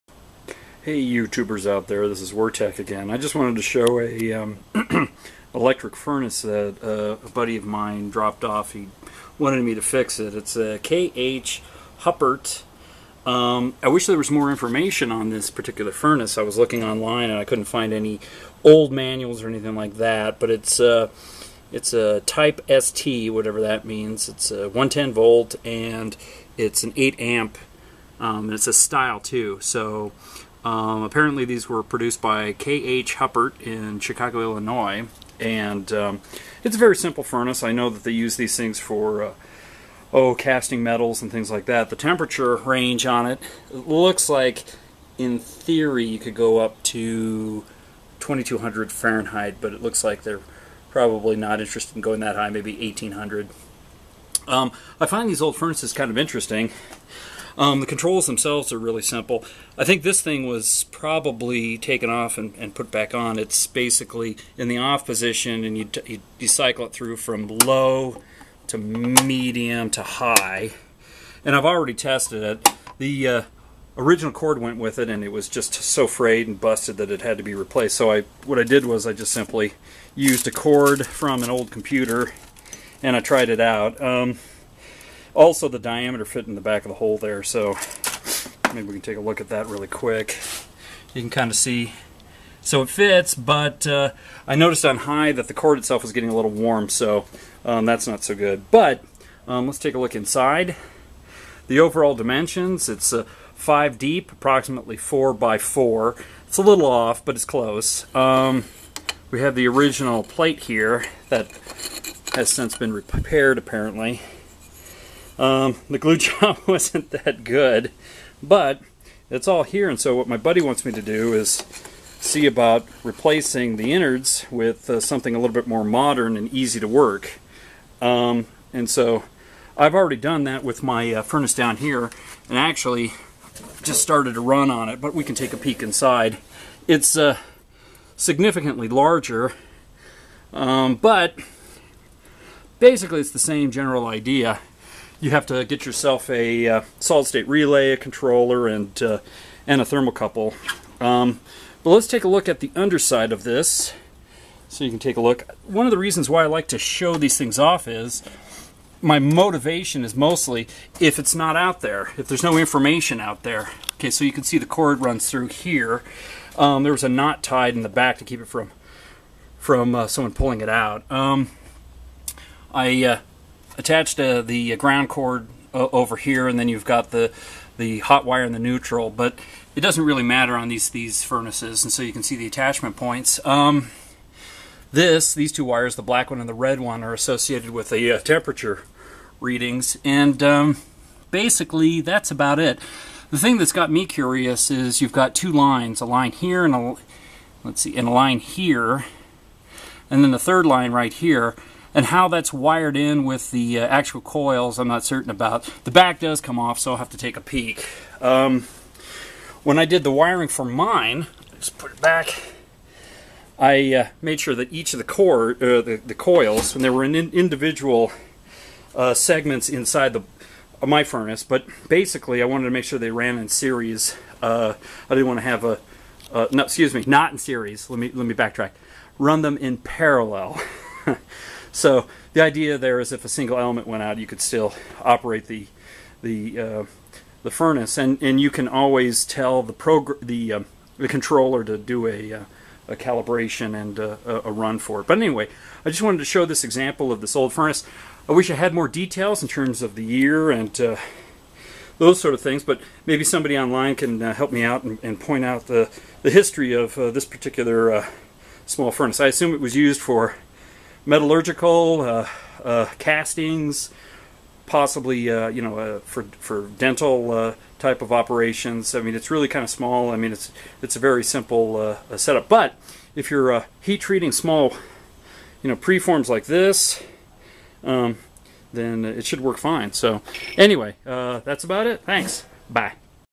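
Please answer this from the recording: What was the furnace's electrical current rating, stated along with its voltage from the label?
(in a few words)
8 amp.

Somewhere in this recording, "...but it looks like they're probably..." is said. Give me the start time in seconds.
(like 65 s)
49 s.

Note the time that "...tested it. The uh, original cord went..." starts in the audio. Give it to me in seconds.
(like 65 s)
71 s.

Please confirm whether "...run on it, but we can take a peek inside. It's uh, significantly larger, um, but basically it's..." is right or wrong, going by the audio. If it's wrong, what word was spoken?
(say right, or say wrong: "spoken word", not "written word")
right.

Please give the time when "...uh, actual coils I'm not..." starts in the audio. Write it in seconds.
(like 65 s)
203 s.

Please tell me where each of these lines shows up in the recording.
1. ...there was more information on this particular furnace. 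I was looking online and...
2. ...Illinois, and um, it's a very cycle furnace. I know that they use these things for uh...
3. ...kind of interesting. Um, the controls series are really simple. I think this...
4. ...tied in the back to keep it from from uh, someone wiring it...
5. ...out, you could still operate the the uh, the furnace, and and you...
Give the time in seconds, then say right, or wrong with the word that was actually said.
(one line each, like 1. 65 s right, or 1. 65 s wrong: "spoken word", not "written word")
1. 14 s right
2. 34 s wrong: "simple", not "cycle"
3. 55 s wrong: "themselves", not "series"
4. 167 s wrong: "pulling", not "wiring"
5. 234 s right.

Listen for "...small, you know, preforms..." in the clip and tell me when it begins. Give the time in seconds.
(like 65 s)
274 s.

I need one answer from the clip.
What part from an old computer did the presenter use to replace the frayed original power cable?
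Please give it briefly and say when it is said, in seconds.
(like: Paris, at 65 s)
a cord, at 80 s.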